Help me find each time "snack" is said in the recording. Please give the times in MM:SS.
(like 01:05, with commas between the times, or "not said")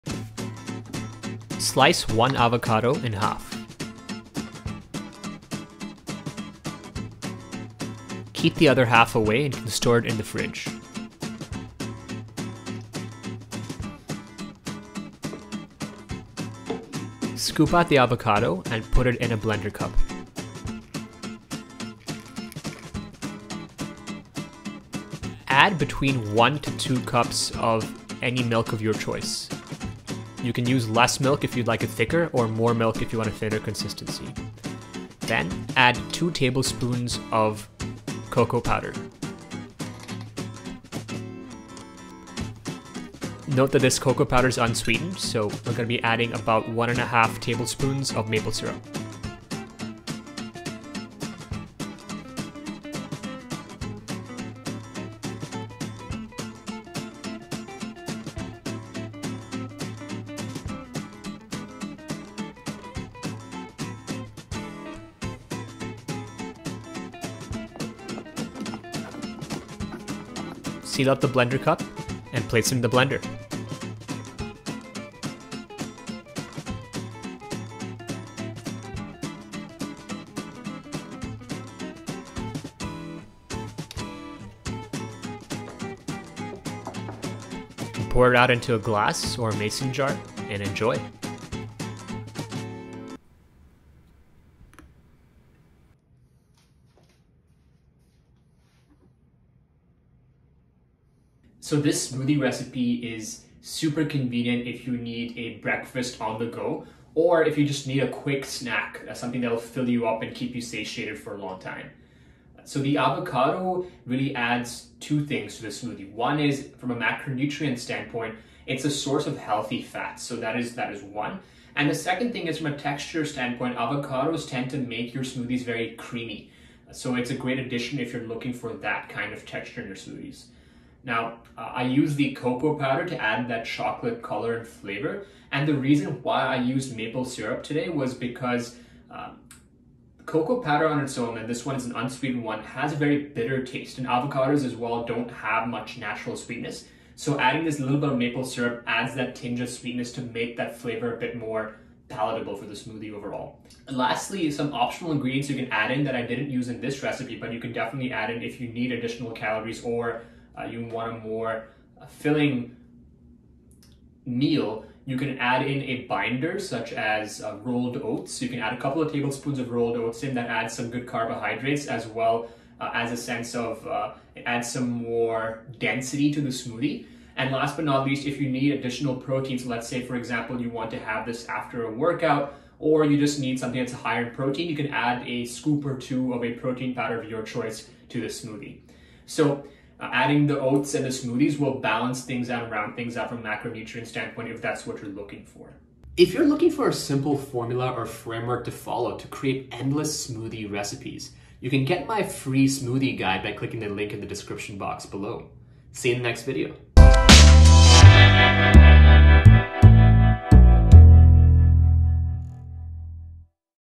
01:48.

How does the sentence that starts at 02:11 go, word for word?
Now, uh, I use the cocoa powder to add that chocolate color and flavor.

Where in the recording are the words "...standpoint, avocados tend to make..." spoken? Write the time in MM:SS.
02:03.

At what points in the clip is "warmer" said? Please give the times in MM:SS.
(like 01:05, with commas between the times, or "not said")
not said.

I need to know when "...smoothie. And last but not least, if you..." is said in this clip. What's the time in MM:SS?
02:56.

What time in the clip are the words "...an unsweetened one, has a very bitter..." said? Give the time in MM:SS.
02:21.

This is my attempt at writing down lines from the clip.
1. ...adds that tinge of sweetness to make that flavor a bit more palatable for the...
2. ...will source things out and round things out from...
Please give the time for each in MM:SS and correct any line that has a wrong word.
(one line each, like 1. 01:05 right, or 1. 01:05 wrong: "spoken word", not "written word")
1. 02:28 right
2. 03:11 wrong: "balance", not "source".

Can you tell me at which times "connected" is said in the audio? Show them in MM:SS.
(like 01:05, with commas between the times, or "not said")
not said.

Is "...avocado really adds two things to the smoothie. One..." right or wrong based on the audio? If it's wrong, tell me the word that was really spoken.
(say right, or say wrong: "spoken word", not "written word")
right.